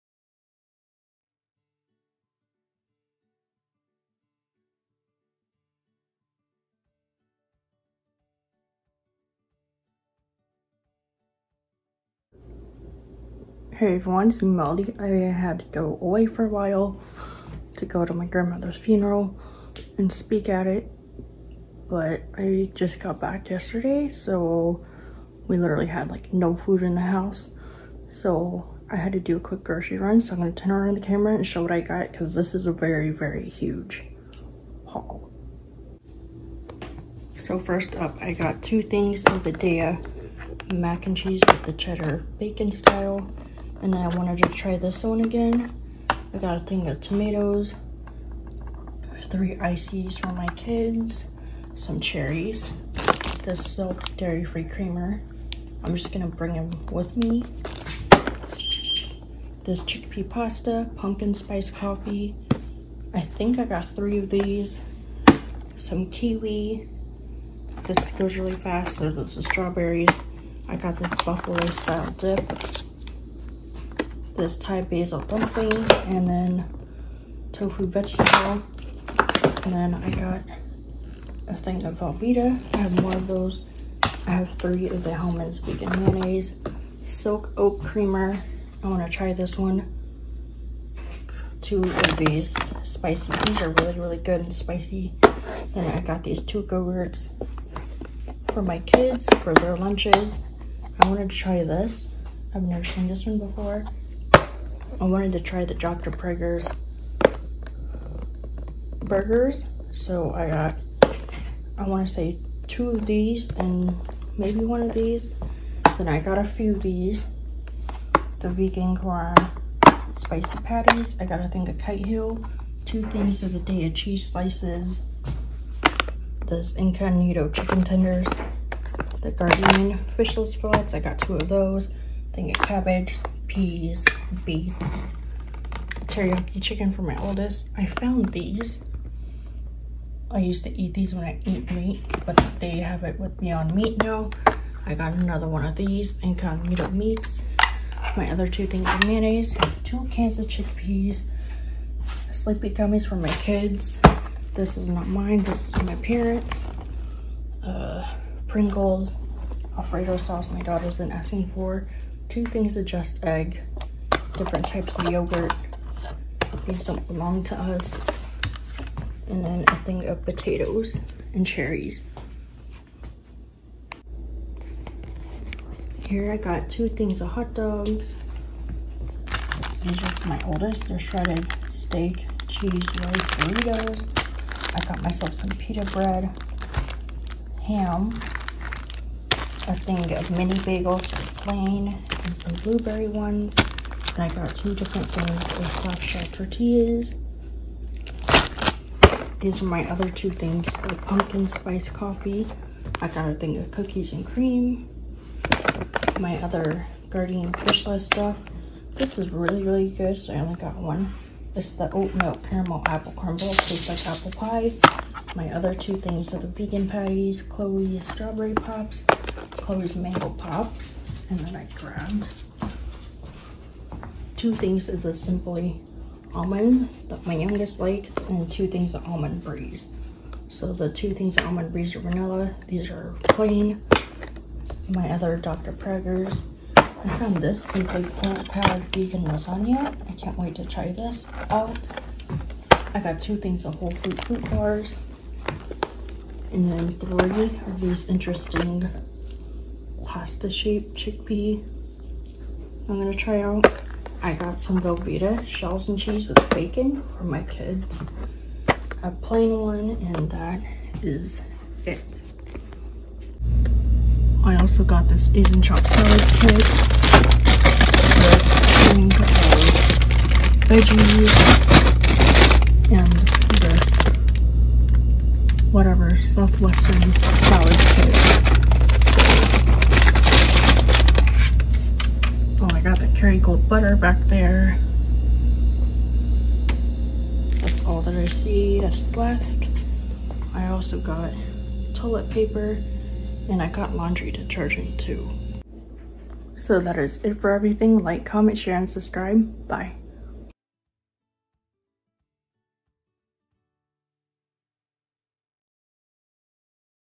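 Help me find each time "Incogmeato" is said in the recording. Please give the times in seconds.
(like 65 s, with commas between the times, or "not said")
126 s, 146 s.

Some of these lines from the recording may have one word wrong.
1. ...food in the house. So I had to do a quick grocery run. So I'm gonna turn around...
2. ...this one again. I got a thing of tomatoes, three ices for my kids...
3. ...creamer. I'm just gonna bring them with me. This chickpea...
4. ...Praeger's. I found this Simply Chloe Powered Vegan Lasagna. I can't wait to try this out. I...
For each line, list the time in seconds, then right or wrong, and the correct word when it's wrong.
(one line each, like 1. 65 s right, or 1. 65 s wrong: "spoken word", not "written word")
1. 26 s right
2. 44 s right
3. 54 s right
4. 235 s wrong: "Plant", not "Chloe".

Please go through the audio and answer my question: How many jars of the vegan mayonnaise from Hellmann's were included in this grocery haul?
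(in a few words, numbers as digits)
3.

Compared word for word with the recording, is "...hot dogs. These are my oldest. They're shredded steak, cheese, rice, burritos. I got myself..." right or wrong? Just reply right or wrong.
right.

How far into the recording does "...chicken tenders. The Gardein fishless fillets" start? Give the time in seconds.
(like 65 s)
127 s.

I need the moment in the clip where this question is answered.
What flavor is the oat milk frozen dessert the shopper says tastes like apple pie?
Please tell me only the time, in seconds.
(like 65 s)
212 s.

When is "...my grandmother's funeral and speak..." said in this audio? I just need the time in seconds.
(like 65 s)
18 s.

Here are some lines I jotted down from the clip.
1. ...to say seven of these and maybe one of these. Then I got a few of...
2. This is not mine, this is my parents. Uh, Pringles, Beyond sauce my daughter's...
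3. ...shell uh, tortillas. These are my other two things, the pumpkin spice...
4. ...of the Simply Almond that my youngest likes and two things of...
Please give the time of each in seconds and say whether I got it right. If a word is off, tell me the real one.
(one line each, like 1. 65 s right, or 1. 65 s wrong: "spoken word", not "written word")
1. 112 s wrong: "two", not "seven"
2. 154 s wrong: "Alfredo", not "Beyond"
3. 196 s right
4. 224 s right.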